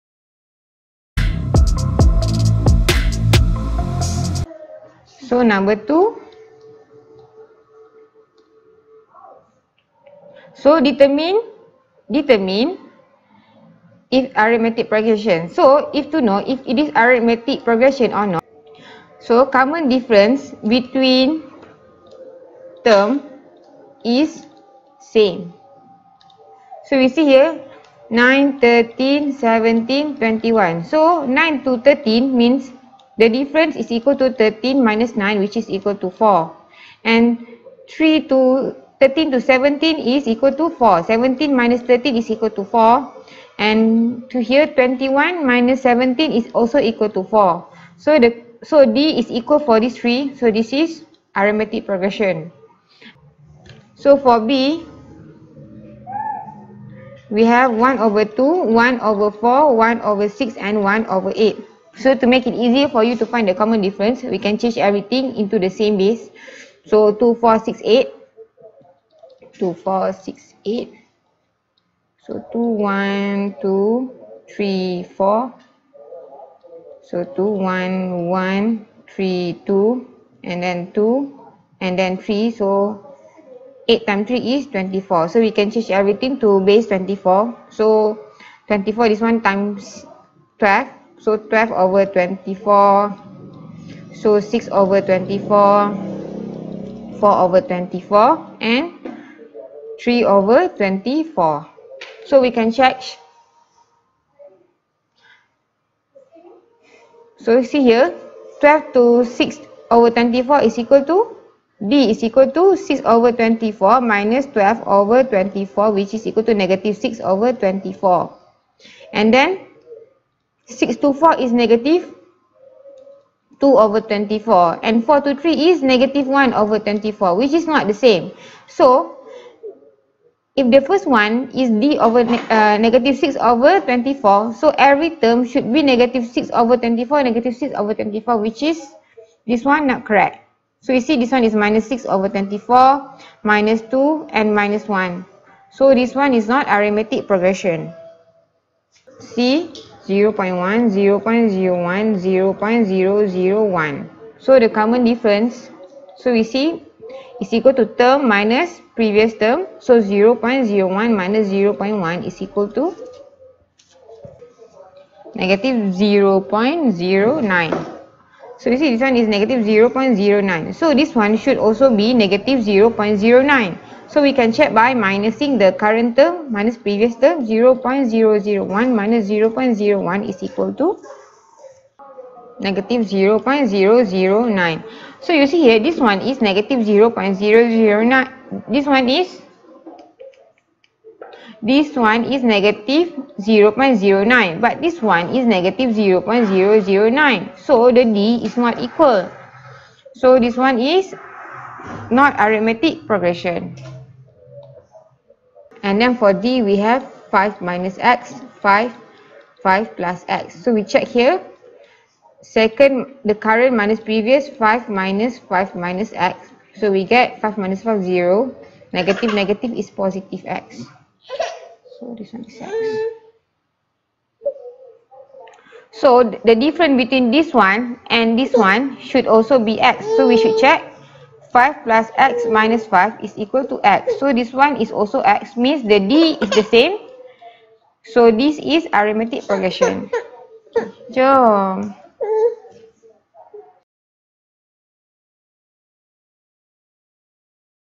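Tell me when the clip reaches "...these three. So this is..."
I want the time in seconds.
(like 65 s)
49 s.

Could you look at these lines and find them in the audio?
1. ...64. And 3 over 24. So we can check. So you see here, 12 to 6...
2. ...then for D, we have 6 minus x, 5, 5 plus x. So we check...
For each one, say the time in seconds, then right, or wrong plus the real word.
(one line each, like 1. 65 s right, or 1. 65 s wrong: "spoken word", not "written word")
1. 97 s wrong: "24", not "64"
2. 206 s wrong: "5", not "6".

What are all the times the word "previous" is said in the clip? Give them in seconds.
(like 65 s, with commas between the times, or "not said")
158 s, 176 s, 213 s.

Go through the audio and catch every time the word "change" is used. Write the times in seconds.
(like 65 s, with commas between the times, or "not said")
64 s, 85 s.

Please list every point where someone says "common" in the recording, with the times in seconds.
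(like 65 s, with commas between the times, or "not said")
19 s, 63 s, 154 s.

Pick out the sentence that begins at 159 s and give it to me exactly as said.
So 0.01 minus 0.1 is equal to negative 0.09.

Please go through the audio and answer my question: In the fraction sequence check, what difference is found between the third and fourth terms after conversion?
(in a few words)
-1/24.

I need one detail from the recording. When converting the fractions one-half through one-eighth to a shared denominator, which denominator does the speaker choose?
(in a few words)
24.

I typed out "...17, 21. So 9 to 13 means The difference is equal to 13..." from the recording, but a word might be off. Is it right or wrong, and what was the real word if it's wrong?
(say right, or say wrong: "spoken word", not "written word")
right.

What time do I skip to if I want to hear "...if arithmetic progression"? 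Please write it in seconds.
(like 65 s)
14 s.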